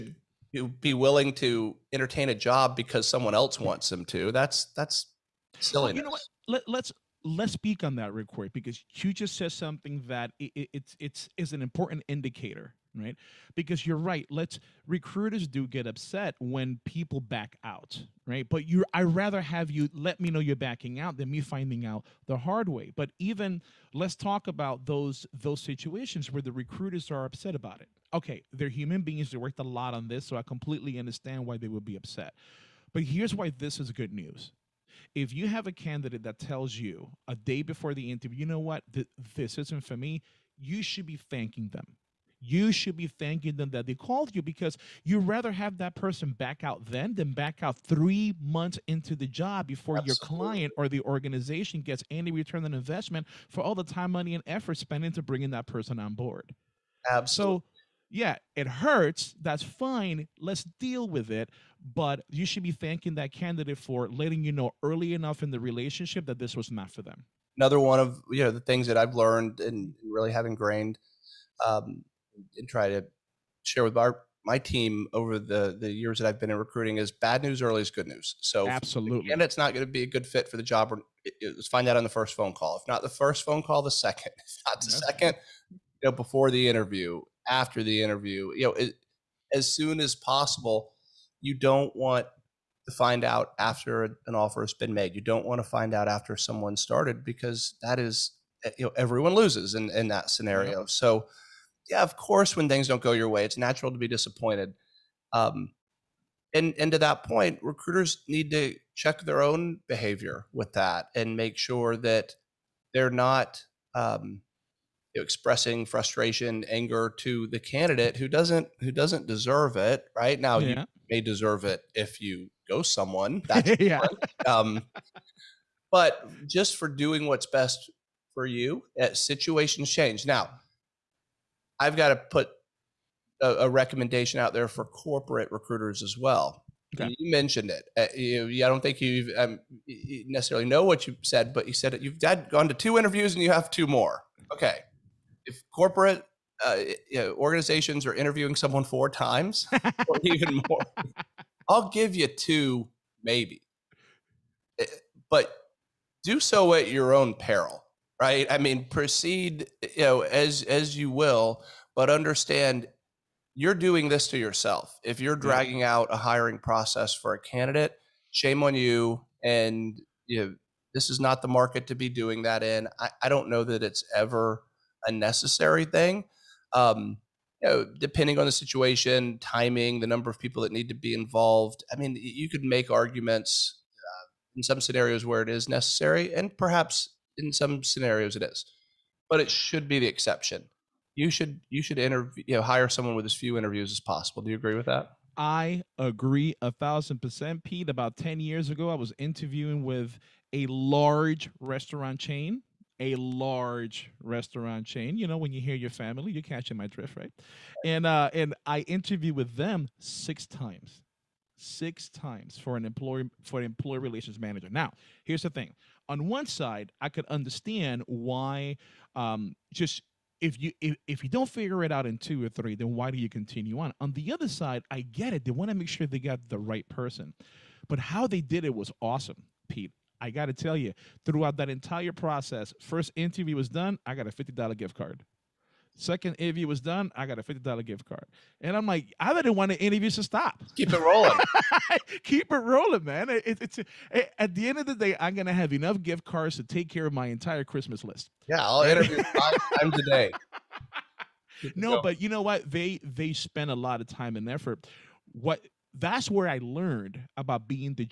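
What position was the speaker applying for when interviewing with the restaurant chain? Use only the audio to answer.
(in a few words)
Employee relations manager.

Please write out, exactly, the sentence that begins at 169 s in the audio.
And you know, this is not the market to be doing that in.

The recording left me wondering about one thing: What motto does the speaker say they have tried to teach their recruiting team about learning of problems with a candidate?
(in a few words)
Bad news early is good news.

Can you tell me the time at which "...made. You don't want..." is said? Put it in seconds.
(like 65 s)
94 s.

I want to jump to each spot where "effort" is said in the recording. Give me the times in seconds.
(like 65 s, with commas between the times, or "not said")
54 s, 254 s.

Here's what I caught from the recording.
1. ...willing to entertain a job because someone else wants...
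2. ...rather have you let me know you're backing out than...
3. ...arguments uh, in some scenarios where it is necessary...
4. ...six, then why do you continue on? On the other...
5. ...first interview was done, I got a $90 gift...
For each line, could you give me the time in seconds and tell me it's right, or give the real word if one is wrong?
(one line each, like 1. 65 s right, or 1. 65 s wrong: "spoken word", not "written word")
1. 0 s right
2. 19 s right
3. 182 s right
4. 222 s wrong: "three", not "six"
5. 232 s wrong: "50", not "90".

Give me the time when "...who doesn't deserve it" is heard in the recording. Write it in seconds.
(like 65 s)
118 s.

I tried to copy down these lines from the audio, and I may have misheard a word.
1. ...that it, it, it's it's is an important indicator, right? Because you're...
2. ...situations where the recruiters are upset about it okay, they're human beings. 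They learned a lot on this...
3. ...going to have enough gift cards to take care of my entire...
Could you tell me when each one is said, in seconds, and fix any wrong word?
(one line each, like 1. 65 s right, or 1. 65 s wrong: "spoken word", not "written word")
1. 10 s right
2. 25 s wrong: "worked", not "learned"
3. 245 s right.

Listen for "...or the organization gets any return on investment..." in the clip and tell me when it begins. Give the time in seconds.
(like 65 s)
50 s.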